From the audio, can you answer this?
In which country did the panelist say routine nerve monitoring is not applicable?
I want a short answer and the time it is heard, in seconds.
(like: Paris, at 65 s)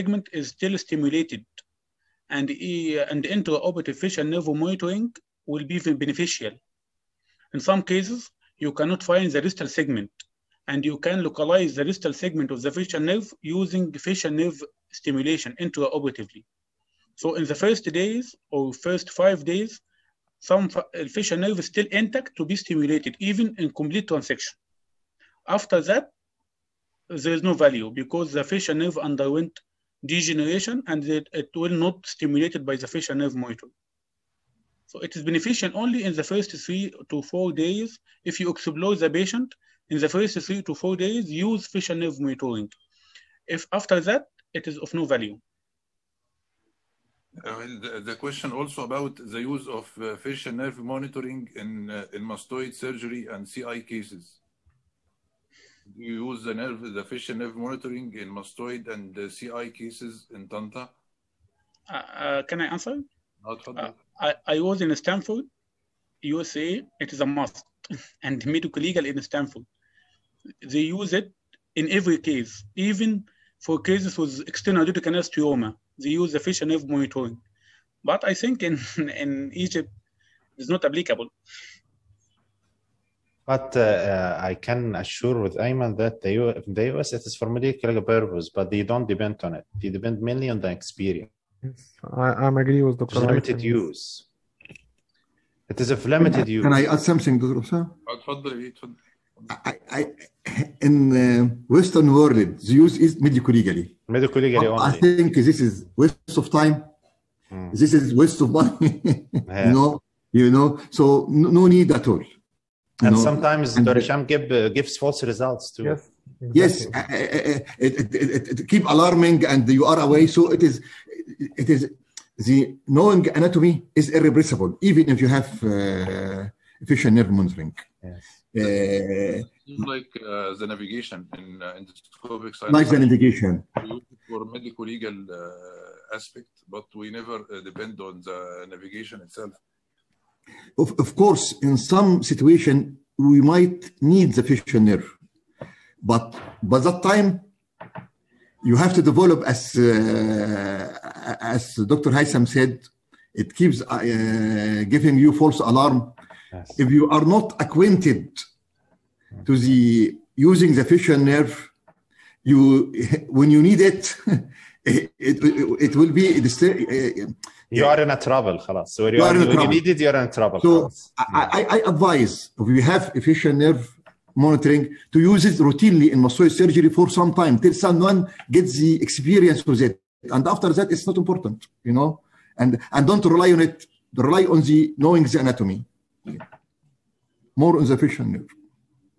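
Egypt, at 79 s.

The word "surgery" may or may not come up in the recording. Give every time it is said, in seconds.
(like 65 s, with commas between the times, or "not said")
52 s, 176 s.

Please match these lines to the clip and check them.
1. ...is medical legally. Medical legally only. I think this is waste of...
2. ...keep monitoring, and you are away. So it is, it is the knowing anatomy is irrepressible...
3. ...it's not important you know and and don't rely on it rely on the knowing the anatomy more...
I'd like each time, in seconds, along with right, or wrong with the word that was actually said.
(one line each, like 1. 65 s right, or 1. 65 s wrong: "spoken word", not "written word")
1. 103 s right
2. 118 s wrong: "alarming", not "monitoring"
3. 180 s right.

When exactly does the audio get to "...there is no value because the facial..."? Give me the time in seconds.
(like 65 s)
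27 s.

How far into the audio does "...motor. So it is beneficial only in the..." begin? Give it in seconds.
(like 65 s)
33 s.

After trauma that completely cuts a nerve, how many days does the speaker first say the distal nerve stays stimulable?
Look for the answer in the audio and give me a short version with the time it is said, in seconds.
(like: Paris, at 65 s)
5, at 18 s.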